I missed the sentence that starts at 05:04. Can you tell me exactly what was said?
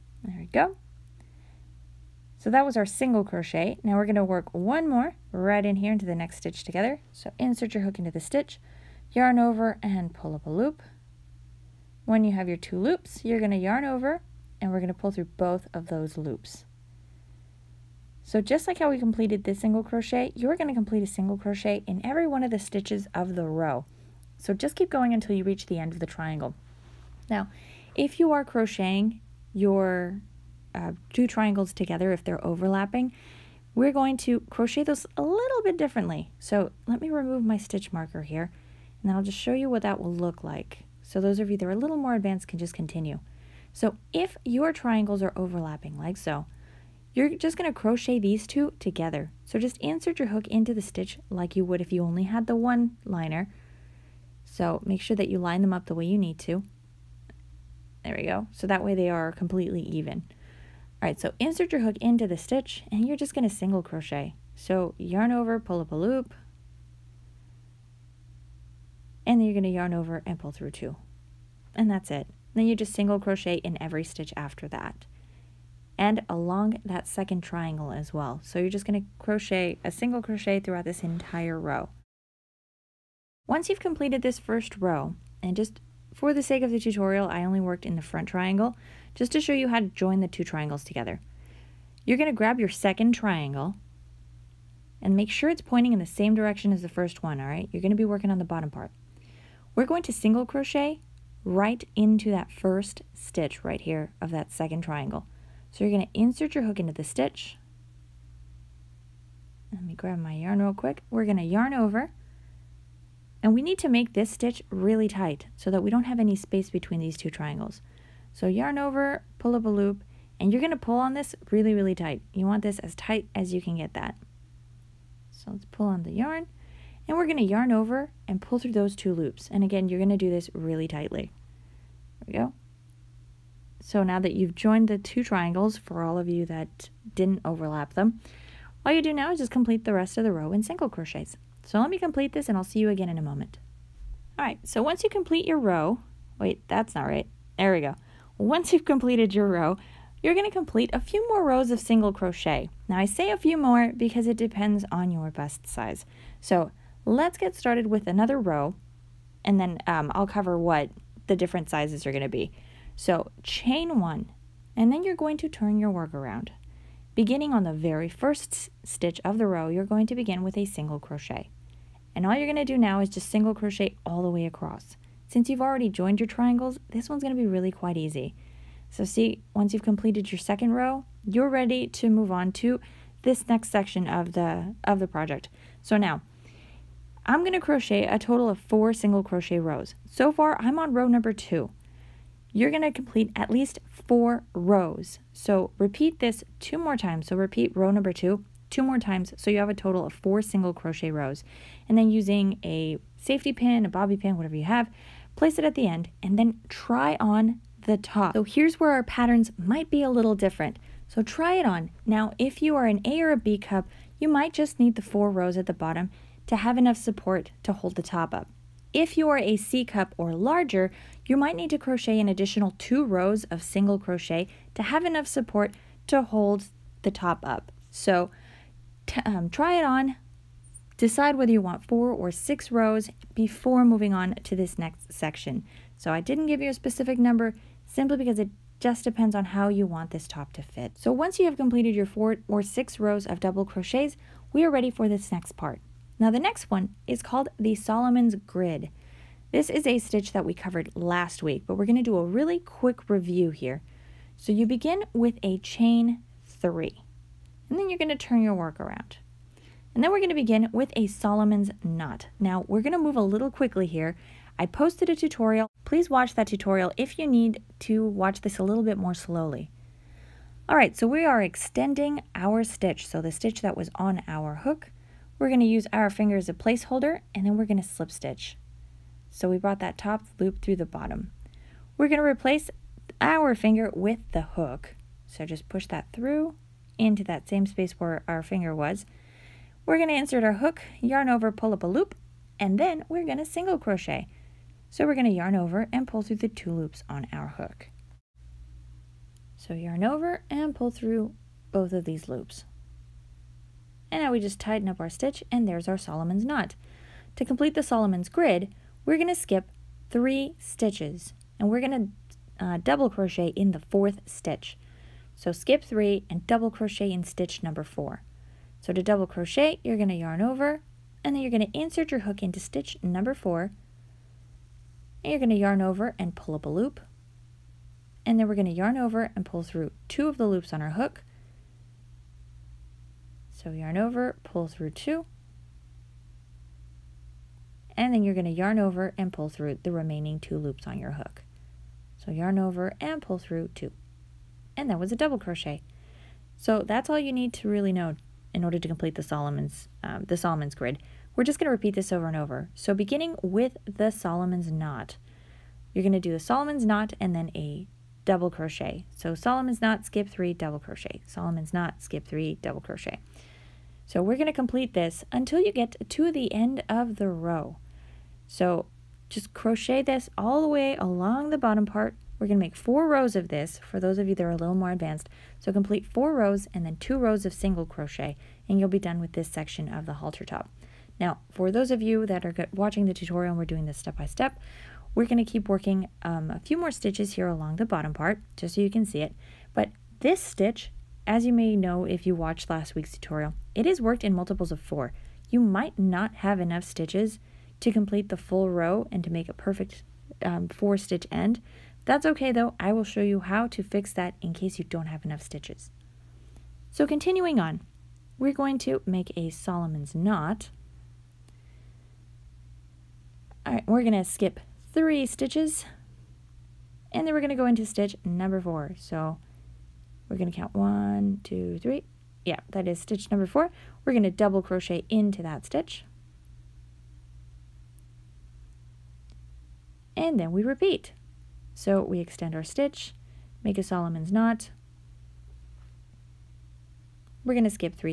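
And now we just tighten up our stitch and there's our Solomon's knot.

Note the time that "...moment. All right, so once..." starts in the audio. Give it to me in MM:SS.
02:23.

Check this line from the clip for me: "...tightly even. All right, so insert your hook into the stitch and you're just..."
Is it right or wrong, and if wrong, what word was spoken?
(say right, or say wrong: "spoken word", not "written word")
wrong: "completely", not "tightly".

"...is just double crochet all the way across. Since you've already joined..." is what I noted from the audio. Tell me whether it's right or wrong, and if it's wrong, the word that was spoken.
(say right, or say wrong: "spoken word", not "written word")
wrong: "single", not "double".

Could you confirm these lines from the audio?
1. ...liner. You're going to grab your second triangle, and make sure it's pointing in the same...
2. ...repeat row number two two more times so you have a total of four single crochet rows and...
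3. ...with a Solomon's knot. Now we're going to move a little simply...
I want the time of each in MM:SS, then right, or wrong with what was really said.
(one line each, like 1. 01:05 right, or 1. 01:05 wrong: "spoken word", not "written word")
1. 01:30 wrong: "together", not "liner"
2. 03:17 right
3. 04:20 wrong: "quickly", not "simply".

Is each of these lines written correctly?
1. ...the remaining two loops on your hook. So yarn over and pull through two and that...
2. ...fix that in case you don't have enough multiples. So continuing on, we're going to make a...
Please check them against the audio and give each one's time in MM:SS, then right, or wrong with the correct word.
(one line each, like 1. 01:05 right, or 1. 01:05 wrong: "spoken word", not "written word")
1. 05:39 right
2. 06:43 wrong: "stitches", not "multiples".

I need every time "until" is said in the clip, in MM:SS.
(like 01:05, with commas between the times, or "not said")
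00:25, 06:05.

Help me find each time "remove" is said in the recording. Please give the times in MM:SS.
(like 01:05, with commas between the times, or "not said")
00:37.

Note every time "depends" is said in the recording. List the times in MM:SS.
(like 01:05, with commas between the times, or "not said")
02:34, 03:59.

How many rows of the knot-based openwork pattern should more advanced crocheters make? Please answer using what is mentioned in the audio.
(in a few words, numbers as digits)
4.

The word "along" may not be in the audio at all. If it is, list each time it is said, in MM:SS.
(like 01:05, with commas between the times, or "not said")
01:16, 06:10, 06:27.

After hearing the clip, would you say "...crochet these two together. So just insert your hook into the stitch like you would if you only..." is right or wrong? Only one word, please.
right.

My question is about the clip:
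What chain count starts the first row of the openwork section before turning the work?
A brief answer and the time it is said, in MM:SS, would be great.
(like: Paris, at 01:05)
chain 3, at 04:15.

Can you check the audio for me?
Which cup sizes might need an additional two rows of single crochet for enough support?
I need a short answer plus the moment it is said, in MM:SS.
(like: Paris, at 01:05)
C cup or larger, at 03:39.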